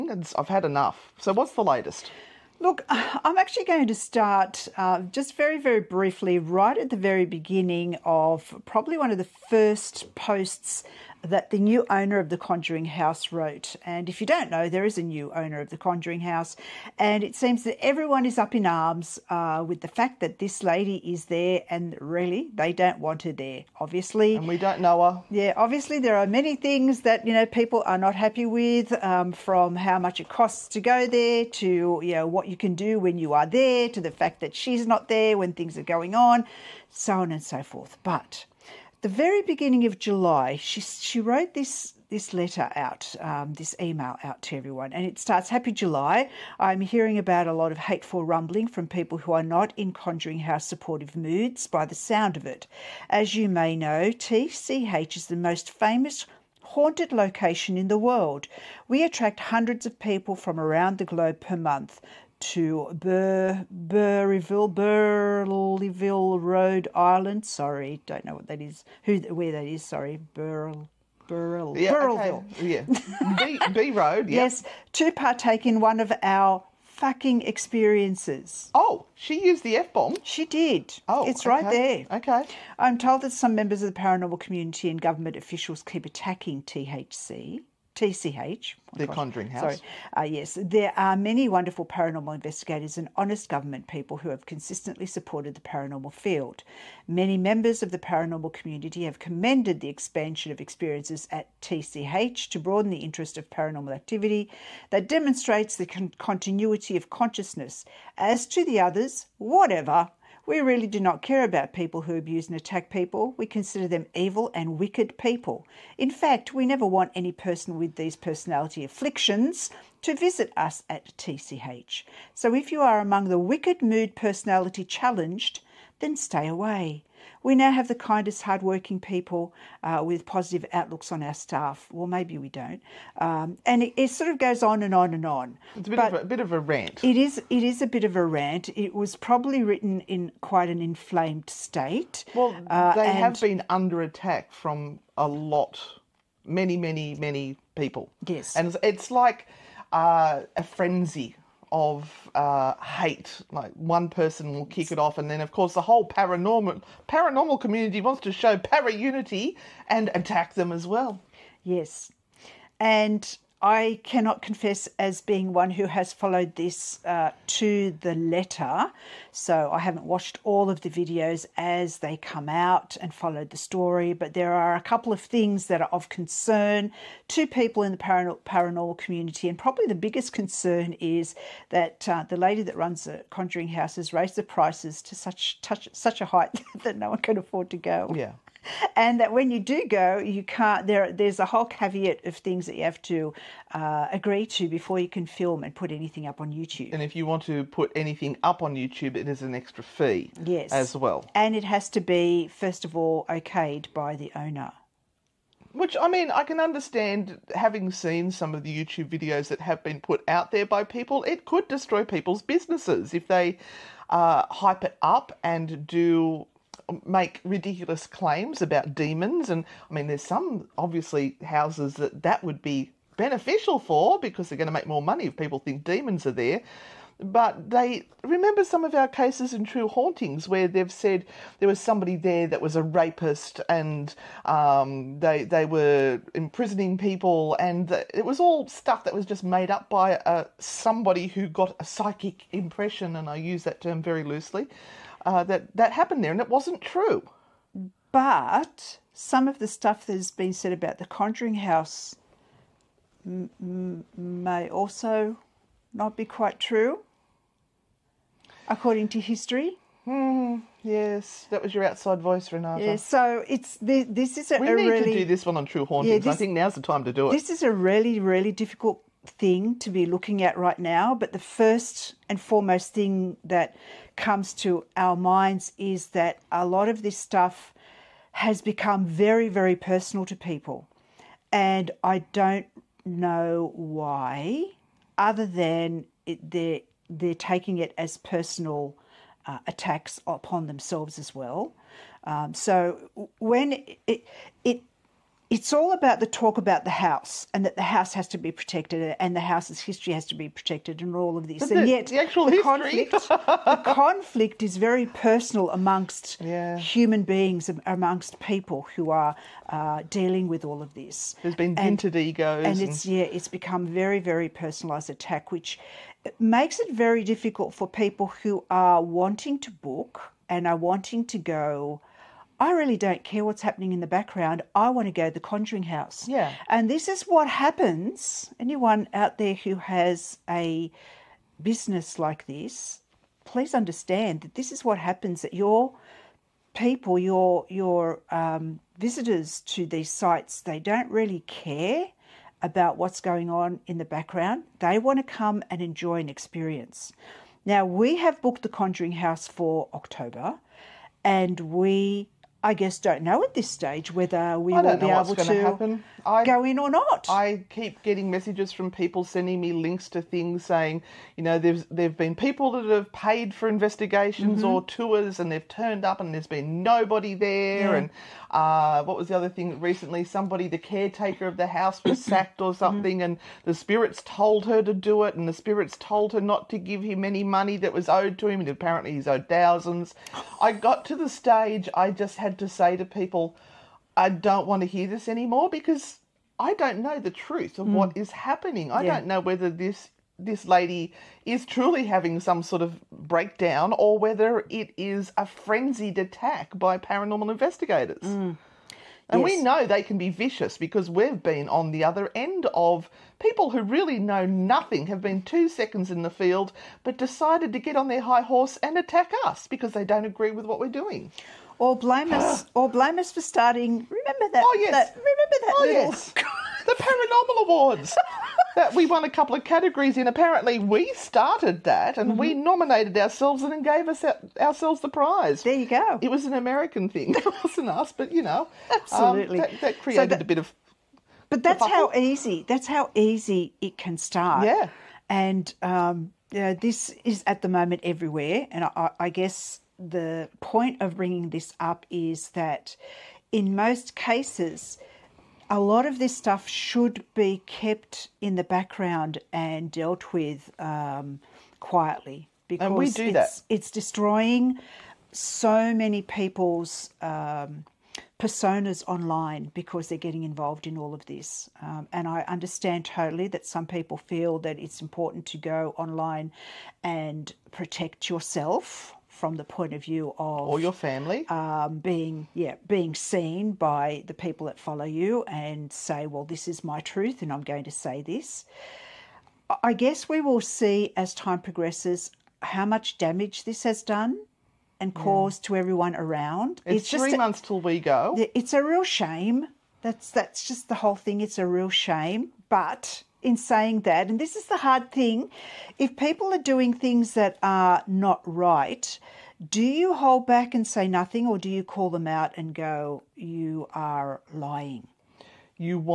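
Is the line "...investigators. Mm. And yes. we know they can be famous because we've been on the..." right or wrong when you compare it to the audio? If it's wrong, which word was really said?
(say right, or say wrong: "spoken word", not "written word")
wrong: "vicious", not "famous".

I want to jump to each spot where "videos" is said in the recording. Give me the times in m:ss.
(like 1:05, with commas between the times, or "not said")
2:50, 3:29.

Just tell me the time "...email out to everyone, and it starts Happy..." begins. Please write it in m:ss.
0:43.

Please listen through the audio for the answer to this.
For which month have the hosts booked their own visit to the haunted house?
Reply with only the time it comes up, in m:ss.
5:49.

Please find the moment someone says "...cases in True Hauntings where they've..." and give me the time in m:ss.
3:49.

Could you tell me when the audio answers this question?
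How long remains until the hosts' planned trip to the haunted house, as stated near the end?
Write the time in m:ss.
8:07.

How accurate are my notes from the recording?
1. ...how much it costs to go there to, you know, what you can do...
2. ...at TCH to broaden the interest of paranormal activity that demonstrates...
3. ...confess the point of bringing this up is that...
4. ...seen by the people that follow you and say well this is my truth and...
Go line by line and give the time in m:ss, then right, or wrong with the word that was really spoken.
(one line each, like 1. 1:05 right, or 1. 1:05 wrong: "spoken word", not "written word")
1. 0:29 right
2. 1:41 right
3. 7:19 wrong: "guess", not "confess"
4. 7:53 right.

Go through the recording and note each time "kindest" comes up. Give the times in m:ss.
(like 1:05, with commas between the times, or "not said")
2:07.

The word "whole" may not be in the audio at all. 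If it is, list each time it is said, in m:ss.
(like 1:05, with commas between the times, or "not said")
2:35, 3:11, 8:11.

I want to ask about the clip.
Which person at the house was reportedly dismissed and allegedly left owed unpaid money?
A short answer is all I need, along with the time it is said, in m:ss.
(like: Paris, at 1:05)
The caretaker, at 6:10.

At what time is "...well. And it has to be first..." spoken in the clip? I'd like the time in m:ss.
3:20.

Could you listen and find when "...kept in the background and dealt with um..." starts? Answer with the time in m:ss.
7:27.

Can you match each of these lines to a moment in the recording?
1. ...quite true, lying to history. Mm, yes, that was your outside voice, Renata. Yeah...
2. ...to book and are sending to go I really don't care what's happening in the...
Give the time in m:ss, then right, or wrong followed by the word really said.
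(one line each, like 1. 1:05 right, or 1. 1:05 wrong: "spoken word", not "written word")
1. 4:16 wrong: "according", not "lying"
2. 5:19 wrong: "wanting", not "sending".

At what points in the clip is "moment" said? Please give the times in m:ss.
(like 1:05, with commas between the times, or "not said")
7:17.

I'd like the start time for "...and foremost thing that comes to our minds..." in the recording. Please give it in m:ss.
4:32.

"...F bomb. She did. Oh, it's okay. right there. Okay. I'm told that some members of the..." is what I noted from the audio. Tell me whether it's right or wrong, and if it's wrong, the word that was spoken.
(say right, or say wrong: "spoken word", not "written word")
right.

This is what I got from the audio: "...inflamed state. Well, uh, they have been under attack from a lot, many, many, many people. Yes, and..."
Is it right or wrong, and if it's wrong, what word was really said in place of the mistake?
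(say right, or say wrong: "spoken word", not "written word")
right.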